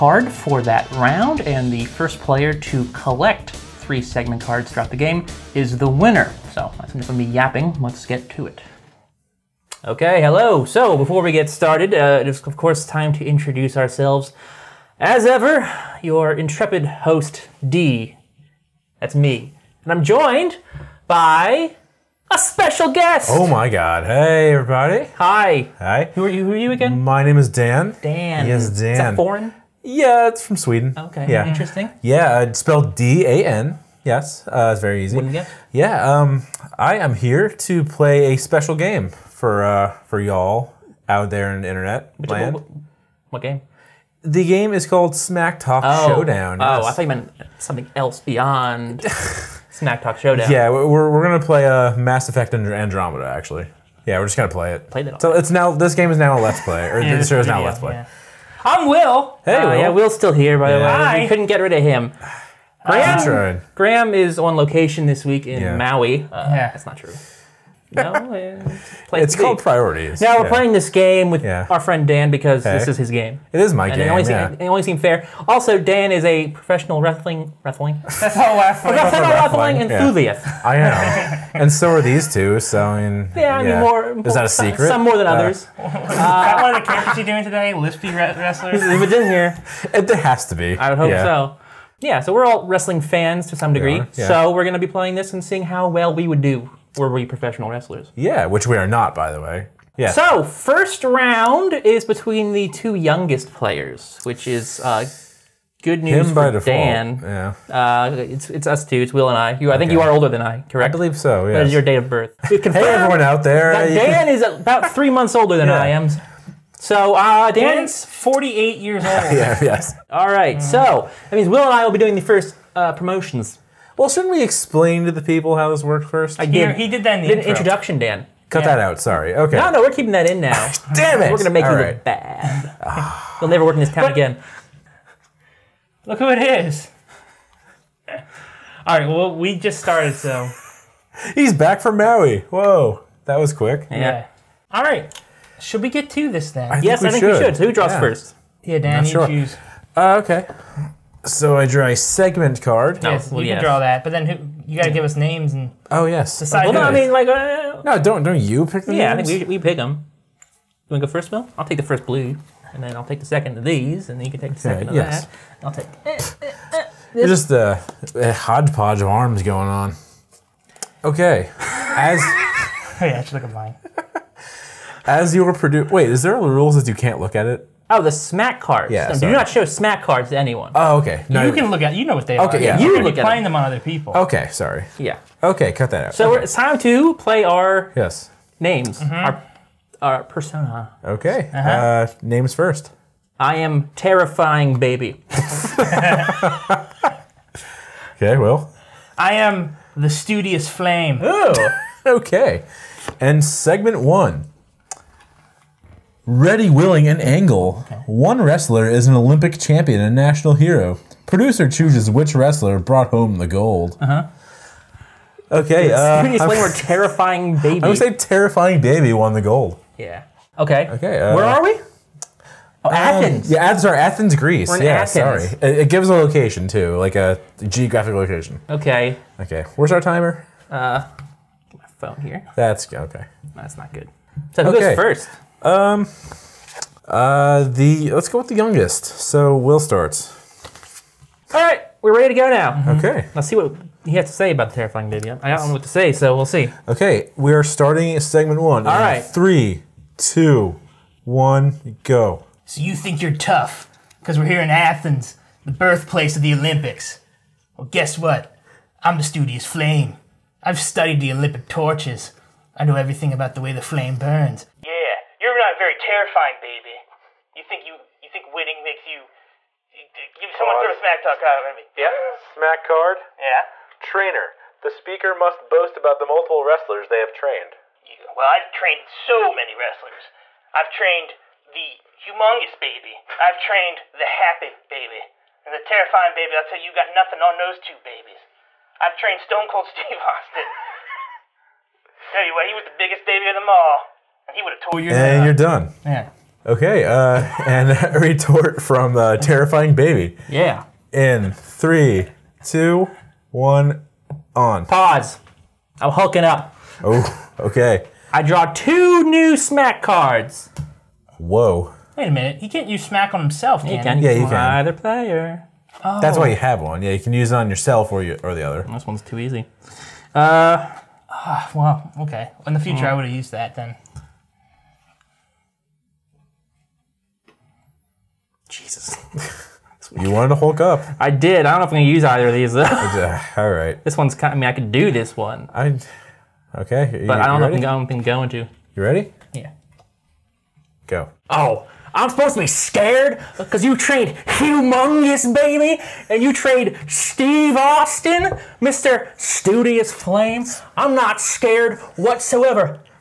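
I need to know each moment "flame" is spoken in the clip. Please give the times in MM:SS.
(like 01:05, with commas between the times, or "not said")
03:20, 04:19, 04:23, 05:50.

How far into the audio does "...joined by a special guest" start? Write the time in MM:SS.
00:20.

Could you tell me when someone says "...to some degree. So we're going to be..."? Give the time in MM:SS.
01:33.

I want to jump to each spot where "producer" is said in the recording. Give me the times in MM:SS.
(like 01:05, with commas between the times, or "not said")
02:55, 03:31.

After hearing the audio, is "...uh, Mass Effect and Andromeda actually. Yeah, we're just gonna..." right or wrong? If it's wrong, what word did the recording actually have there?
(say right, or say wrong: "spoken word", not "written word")
right.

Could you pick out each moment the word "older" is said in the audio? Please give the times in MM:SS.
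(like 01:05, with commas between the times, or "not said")
01:50, 01:55.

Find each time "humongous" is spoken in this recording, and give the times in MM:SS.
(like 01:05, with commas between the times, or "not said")
04:42, 05:44.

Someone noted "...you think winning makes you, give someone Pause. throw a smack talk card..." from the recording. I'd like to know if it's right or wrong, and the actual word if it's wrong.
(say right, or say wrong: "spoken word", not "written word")
right.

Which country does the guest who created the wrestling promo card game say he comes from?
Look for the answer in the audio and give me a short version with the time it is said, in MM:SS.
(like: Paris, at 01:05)
Sweden, at 00:30.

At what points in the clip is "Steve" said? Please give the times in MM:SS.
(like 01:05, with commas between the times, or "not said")
04:49, 05:47.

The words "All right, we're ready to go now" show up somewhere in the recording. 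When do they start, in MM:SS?
04:01.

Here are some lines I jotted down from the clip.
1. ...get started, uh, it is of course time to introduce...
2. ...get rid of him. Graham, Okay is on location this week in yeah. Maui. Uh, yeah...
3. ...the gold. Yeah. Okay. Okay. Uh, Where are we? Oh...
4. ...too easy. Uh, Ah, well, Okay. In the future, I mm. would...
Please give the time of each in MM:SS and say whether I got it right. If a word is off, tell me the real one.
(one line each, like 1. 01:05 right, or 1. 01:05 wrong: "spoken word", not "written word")
1. 00:11 right
2. 01:01 wrong: "Graham", not "Okay"
3. 03:39 right
4. 05:19 right.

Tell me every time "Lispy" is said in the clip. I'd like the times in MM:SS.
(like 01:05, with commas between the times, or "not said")
01:27.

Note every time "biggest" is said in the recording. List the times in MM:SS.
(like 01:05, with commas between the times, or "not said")
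04:52.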